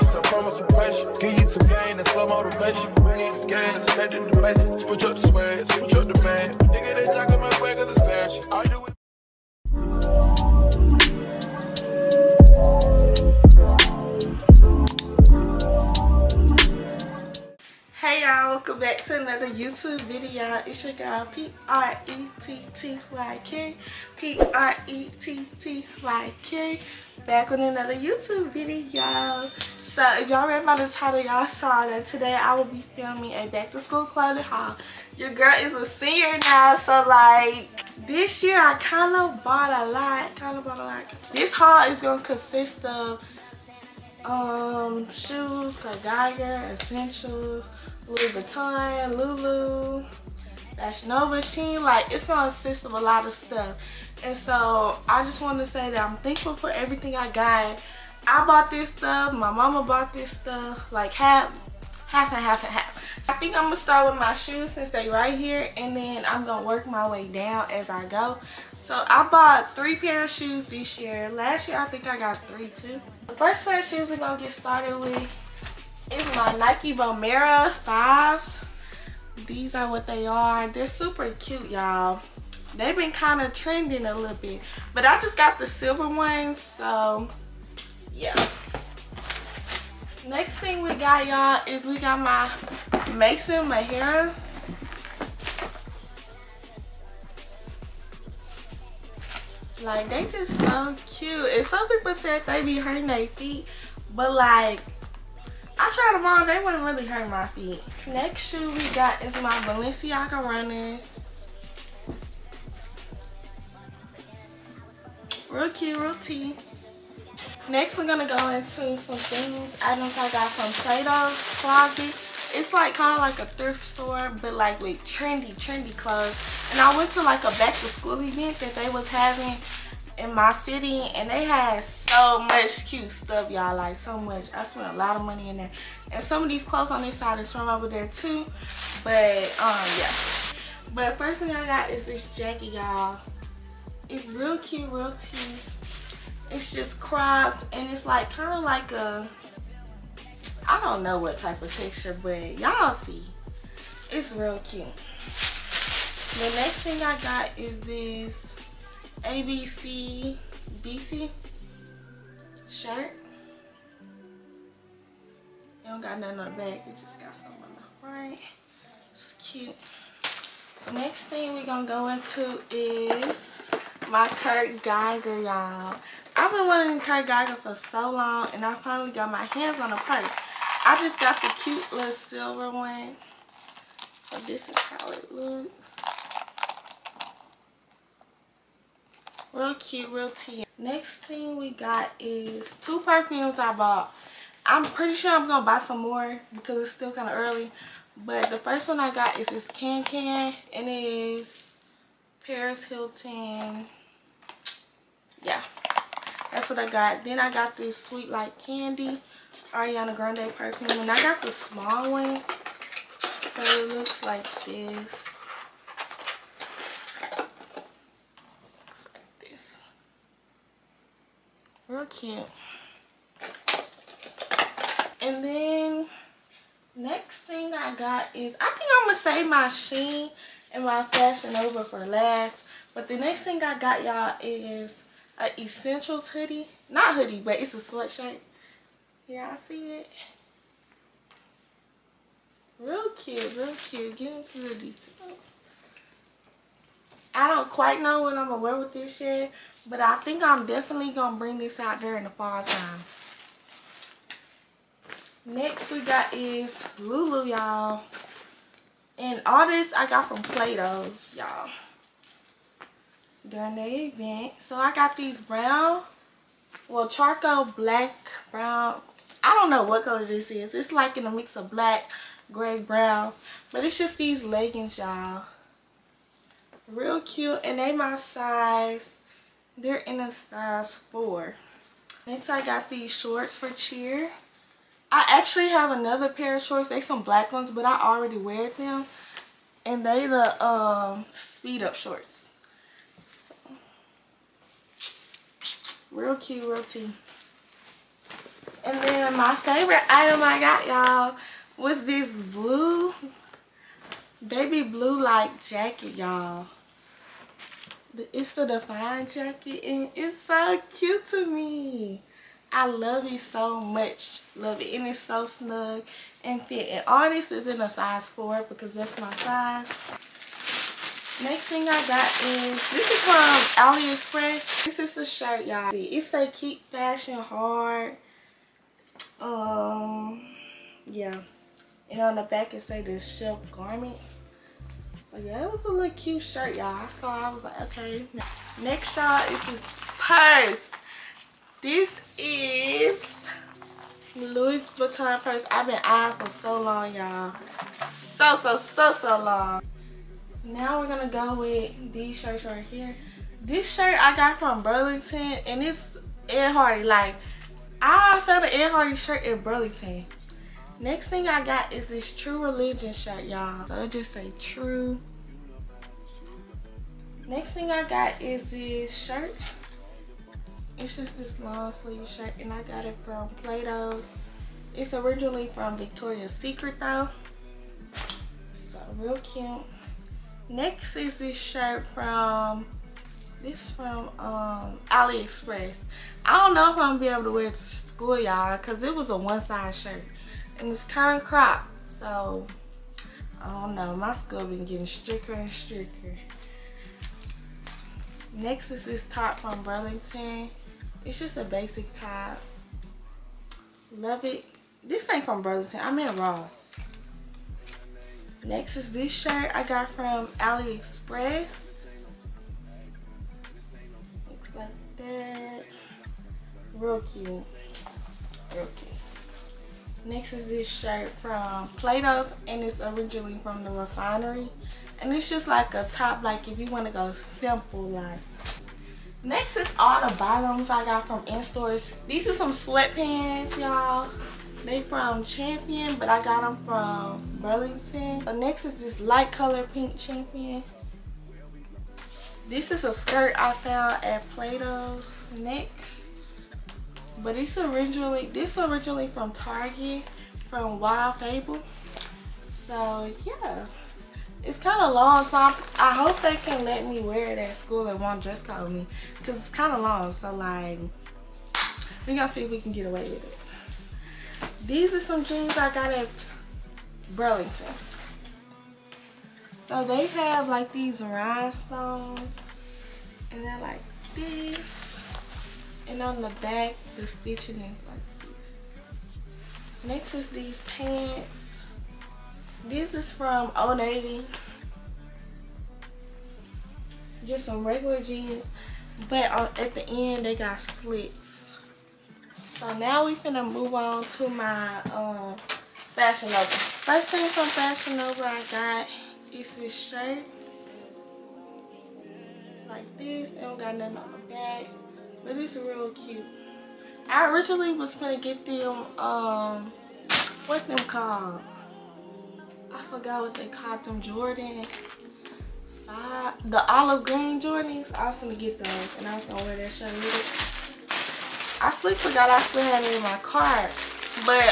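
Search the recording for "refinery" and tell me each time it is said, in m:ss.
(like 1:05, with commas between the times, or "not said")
7:03.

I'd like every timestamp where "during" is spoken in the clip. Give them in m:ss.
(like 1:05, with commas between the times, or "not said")
4:12, 4:23.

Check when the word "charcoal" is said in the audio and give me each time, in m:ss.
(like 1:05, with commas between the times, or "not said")
4:27.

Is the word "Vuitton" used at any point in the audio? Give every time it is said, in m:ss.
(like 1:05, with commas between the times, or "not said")
0:48, 5:44.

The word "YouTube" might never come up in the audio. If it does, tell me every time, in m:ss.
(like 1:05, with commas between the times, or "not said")
0:19, 0:27.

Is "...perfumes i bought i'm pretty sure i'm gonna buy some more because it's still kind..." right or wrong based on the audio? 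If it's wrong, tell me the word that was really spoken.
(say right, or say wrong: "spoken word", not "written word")
right.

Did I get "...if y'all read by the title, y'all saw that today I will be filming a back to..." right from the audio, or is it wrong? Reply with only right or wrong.
right.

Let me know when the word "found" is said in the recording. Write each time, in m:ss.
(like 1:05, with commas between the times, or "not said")
5:58, 7:23.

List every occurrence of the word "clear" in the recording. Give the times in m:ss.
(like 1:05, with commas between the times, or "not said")
not said.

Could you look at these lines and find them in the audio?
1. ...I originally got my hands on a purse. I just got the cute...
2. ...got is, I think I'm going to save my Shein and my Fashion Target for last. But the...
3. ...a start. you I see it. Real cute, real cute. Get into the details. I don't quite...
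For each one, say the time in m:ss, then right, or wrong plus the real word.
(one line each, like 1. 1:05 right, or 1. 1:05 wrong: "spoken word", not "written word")
1. 2:58 wrong: "finally", not "originally"
2. 3:47 wrong: "Nova", not "Target"
3. 3:57 wrong: "sweatshirt", not "start".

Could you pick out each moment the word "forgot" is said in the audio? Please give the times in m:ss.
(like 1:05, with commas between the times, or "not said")
8:33, 8:42.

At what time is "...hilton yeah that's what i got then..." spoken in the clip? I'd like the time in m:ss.
3:22.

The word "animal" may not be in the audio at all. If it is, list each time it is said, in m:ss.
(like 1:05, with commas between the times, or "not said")
not said.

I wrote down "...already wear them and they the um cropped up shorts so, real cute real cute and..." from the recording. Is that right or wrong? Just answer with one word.
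wrong.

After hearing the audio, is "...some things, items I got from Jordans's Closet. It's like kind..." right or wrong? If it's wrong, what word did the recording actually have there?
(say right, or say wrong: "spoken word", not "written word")
wrong: "Plato", not "Jordans".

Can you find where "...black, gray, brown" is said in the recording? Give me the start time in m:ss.
4:31.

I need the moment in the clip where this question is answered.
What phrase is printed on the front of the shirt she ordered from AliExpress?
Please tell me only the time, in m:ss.
5:26.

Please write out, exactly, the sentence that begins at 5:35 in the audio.
But yeah, it was a little cute shirt, y'all.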